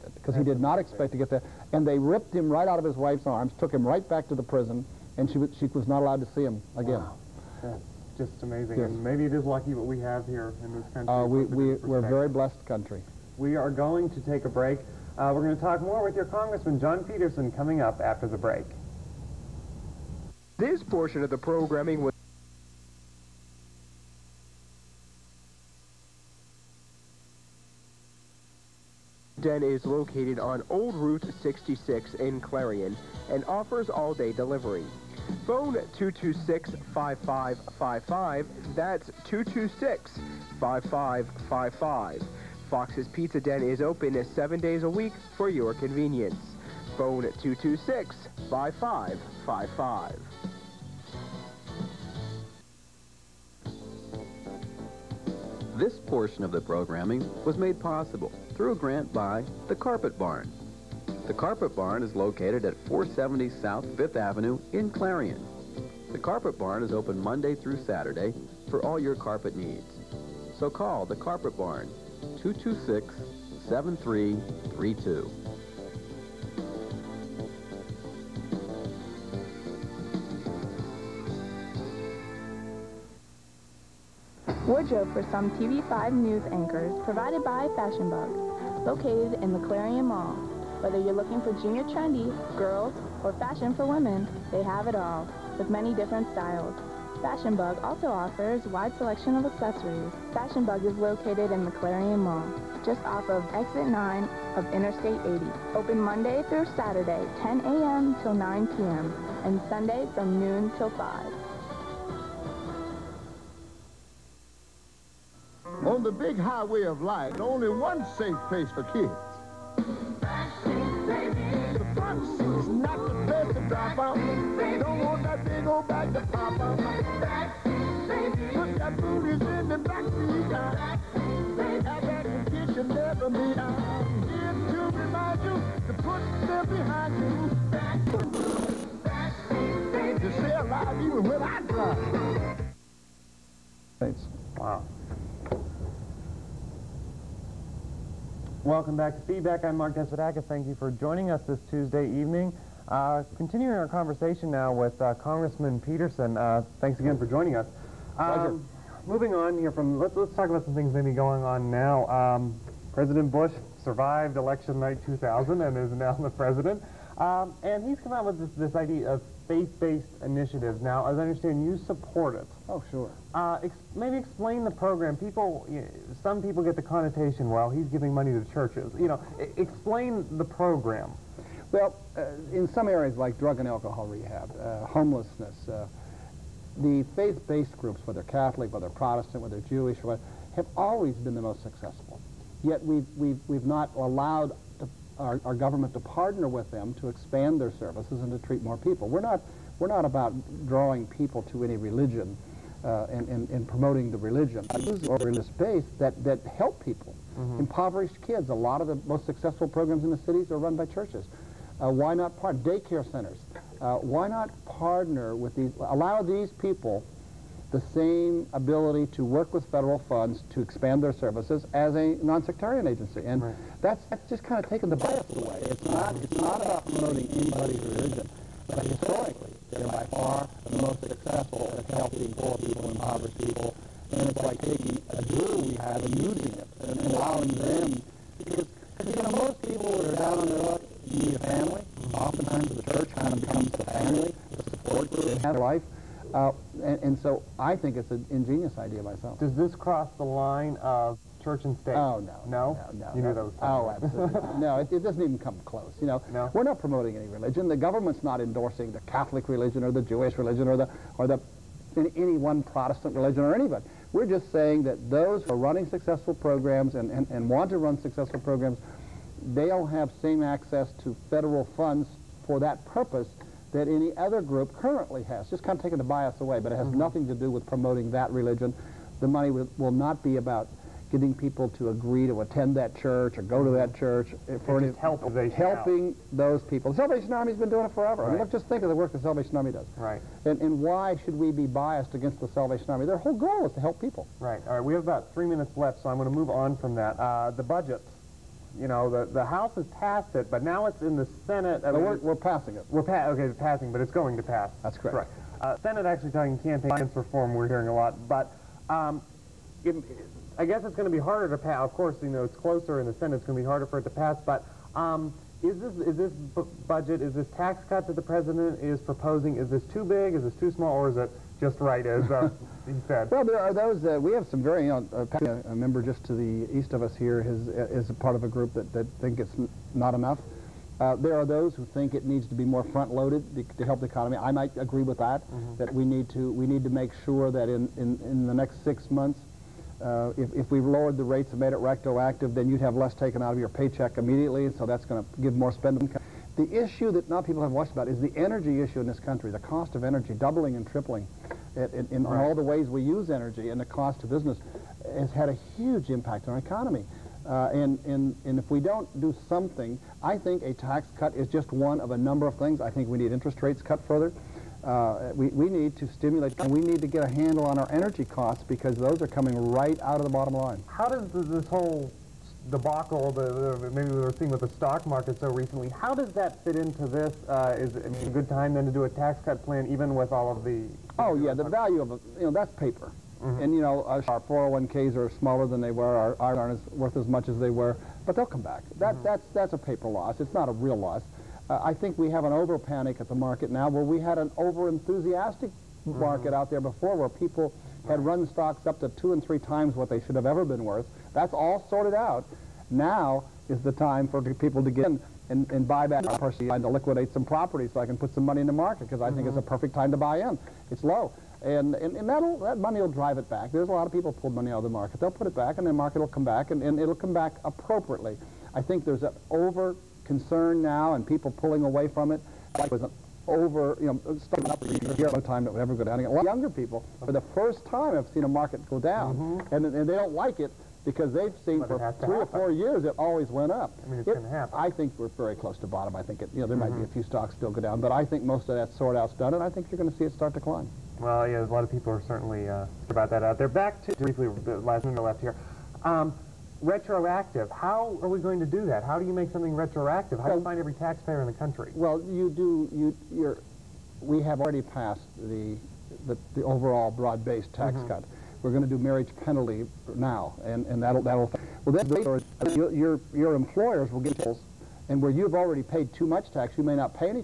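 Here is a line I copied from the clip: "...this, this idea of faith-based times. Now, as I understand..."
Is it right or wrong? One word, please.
wrong.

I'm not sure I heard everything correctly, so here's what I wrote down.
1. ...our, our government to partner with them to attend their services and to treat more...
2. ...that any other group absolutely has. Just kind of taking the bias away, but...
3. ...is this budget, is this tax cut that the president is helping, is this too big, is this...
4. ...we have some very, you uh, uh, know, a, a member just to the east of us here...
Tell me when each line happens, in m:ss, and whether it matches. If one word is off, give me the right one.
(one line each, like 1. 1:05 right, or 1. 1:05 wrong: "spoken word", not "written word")
1. 3:15 wrong: "expand", not "attend"
2. 4:33 wrong: "currently", not "absolutely"
3. 5:16 wrong: "proposing", not "helping"
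4. 5:24 right.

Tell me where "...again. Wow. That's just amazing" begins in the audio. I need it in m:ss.
0:06.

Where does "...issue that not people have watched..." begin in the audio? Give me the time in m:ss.
5:46.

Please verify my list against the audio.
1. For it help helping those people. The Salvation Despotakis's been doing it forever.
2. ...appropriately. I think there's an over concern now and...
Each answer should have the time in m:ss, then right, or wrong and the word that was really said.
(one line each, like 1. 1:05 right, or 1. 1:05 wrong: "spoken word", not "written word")
1. 4:44 wrong: "Army", not "Despotakis"
2. 6:57 right.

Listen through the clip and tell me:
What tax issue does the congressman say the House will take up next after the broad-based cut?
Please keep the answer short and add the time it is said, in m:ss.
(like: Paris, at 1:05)
marriage penalty, at 7:39.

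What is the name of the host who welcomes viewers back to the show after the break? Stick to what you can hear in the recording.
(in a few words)
Mark Despotakis.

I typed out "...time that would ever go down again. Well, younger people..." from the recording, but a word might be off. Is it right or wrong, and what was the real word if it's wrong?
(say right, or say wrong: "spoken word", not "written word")
right.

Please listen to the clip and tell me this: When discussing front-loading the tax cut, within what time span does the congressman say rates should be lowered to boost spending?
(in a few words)
six months.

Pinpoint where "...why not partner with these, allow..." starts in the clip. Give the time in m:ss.
3:34.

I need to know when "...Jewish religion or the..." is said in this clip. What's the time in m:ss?
4:20.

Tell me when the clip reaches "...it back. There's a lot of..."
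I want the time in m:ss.
6:53.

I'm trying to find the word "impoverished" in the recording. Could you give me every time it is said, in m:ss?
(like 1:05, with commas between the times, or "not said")
3:27, 3:52.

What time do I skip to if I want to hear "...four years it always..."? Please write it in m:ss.
7:12.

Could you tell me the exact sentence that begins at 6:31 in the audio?
Uh, I think we have an over panic at the market now where we had an over enthusiastic mm.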